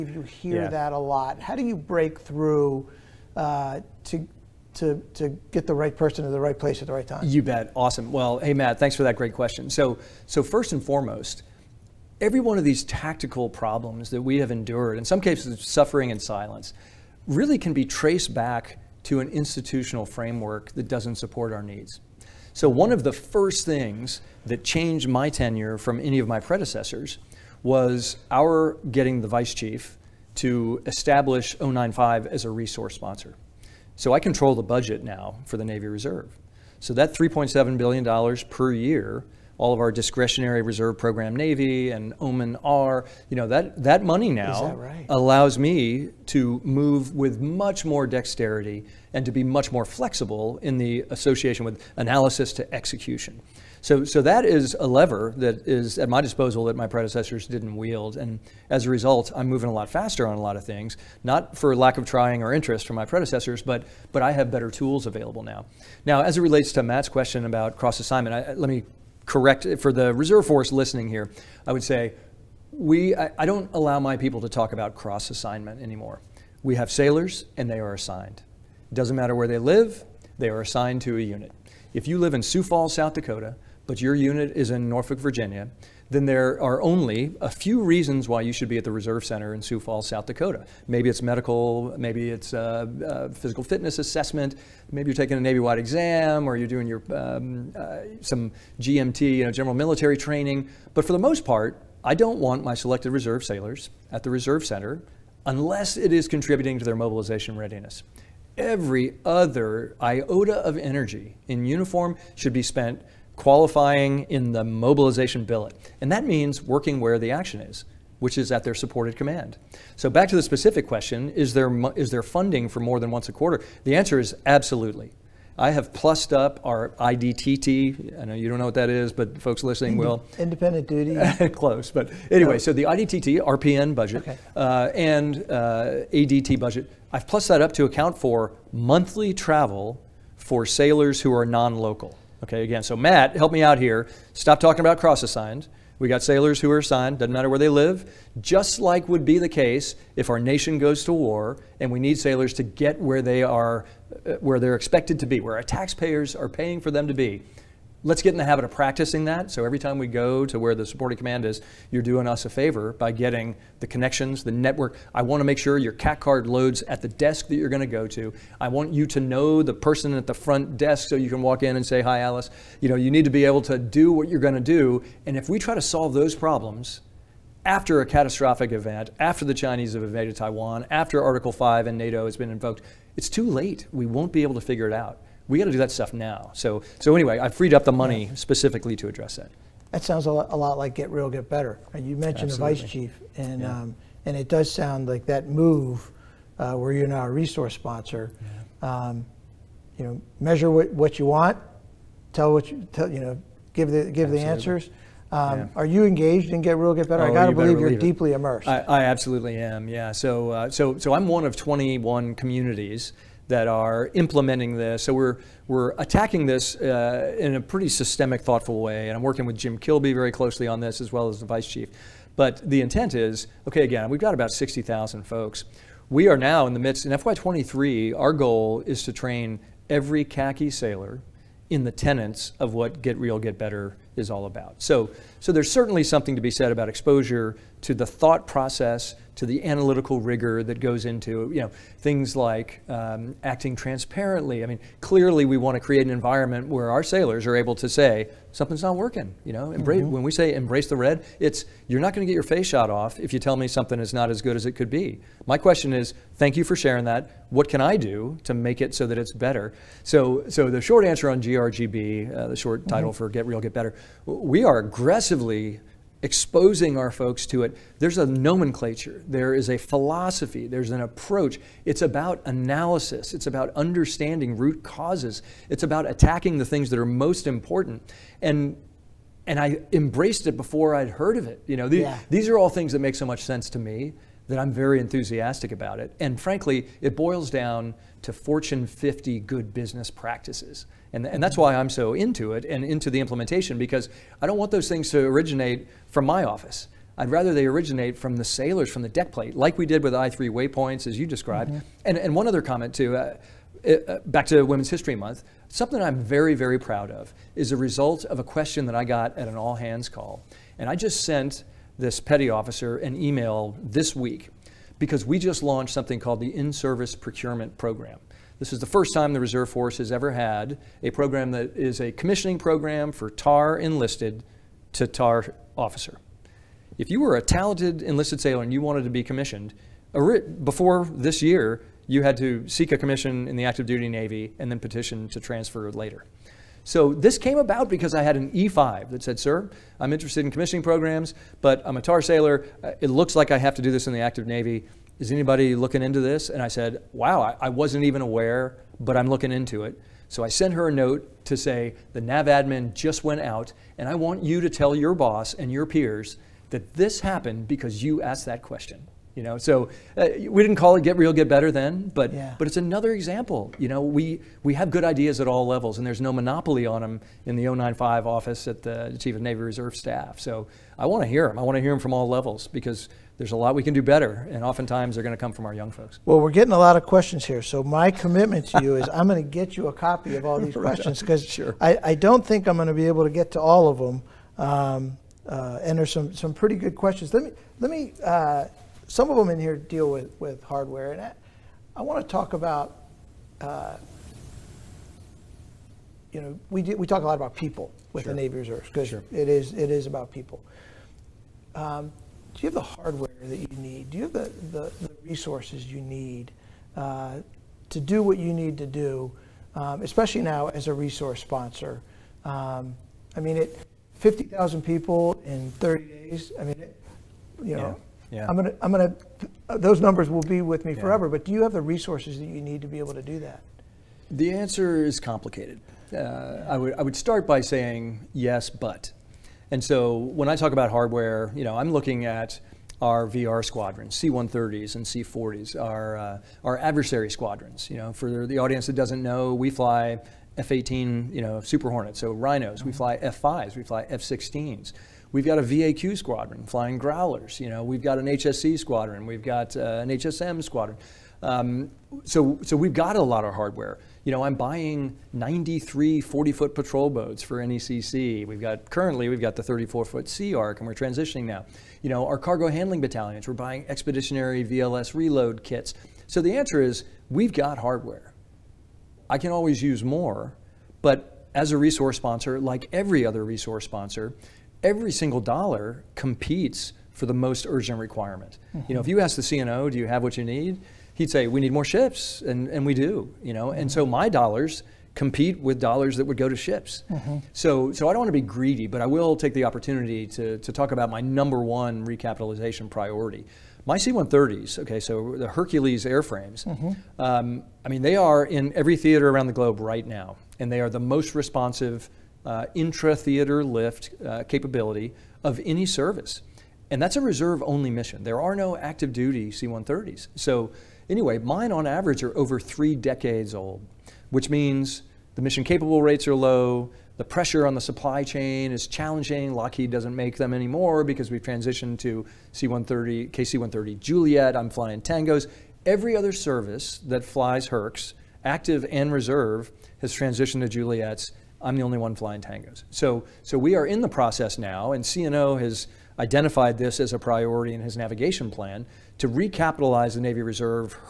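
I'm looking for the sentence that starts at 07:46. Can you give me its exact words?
So the answer is we've got hardware.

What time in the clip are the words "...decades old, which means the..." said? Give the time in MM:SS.
08:32.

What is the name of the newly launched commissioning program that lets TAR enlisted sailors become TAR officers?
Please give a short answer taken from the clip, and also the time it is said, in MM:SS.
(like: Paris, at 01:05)
In Service Procurement Program, at 05:16.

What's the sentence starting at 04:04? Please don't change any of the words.
I mean, clearly we want to create an environment where our sailors are able to say something's not working.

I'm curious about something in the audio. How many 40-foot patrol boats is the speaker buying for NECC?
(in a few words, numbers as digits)
93.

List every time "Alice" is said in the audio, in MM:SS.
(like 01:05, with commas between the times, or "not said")
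02:52.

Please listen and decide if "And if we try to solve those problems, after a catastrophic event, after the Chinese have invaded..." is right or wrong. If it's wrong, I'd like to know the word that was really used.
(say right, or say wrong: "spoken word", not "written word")
right.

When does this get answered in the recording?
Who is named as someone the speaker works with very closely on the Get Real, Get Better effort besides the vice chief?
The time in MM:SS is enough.
03:39.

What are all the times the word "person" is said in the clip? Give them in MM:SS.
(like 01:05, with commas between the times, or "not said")
00:05, 02:49.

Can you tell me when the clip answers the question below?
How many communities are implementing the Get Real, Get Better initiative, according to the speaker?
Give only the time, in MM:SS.
03:31.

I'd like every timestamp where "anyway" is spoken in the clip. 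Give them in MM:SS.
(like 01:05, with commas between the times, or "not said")
02:12, 03:07, 08:31.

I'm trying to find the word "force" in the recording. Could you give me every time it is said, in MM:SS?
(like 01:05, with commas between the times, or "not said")
01:10, 05:19.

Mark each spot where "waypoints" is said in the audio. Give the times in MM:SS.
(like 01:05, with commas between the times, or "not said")
05:00.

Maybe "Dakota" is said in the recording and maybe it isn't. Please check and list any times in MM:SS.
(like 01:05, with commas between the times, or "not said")
01:23, 01:30.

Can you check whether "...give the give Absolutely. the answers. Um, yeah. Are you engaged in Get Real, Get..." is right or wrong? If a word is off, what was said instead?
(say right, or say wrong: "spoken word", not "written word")
right.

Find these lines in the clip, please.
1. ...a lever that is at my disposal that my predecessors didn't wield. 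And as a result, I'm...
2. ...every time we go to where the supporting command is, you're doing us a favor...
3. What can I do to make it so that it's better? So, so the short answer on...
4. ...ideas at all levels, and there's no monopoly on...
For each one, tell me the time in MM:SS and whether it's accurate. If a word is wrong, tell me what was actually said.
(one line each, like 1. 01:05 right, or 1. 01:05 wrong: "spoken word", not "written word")
1. 00:54 right
2. 02:39 right
3. 04:17 right
4. 06:05 right.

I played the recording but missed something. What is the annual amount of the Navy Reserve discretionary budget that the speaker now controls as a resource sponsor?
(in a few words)
$3.7 billion.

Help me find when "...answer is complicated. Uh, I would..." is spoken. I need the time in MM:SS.
07:04.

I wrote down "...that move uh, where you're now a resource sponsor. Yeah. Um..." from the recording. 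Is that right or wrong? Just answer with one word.
right.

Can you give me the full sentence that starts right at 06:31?
And I, I want to talk about, uh, you know, we, do, we talk a lot about people with sure.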